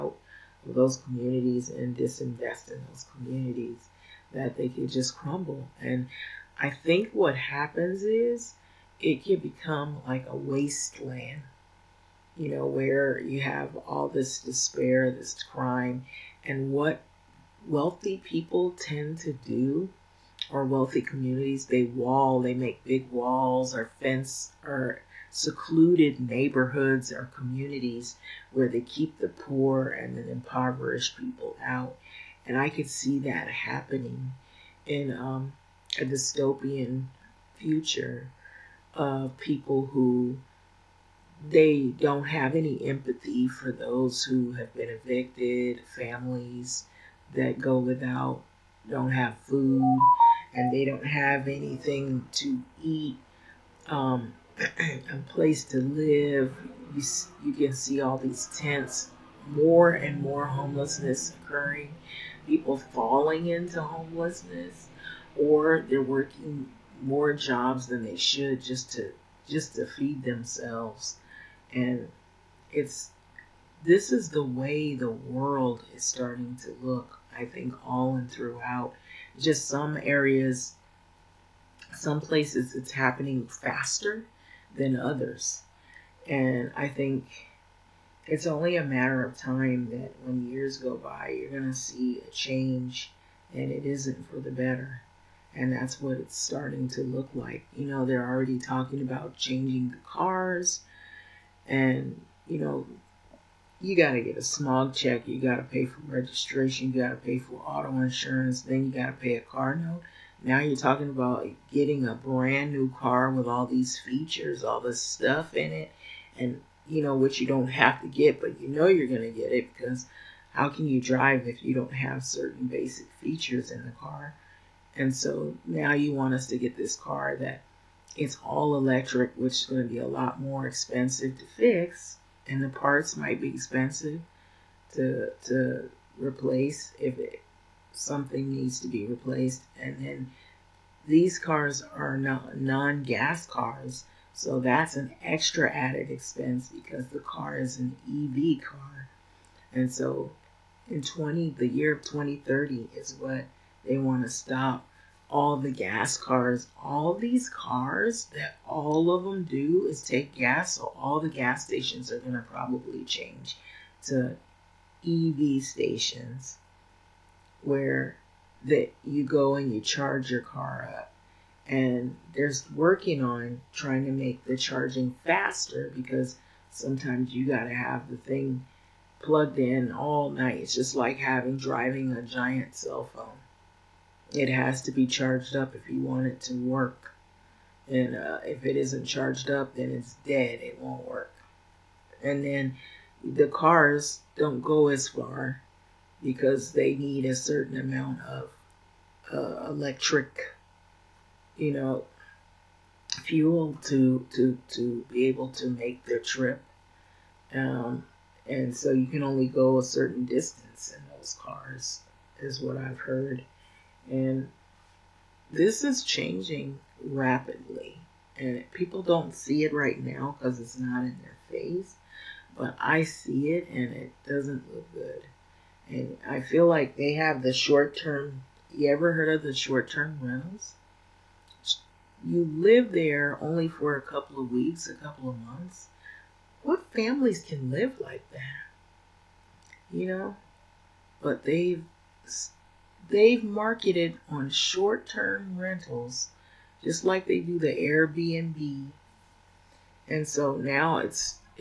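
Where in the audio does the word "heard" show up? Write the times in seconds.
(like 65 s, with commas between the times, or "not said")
212 s, 229 s.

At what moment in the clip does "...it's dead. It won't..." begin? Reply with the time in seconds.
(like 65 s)
189 s.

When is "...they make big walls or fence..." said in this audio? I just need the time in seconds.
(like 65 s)
22 s.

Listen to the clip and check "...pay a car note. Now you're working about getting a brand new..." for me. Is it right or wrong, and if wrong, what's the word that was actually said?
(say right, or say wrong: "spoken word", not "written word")
wrong: "talking", not "working".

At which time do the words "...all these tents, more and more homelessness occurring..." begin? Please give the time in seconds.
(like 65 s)
58 s.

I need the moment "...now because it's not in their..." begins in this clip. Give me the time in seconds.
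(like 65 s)
220 s.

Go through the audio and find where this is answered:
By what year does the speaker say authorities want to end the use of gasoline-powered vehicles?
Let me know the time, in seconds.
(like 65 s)
151 s.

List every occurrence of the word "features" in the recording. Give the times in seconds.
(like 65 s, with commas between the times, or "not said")
113 s, 123 s.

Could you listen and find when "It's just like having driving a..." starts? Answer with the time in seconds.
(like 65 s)
180 s.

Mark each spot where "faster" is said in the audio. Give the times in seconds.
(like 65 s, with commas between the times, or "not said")
83 s, 175 s.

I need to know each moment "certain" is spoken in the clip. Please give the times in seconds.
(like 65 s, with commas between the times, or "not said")
122 s, 197 s, 209 s.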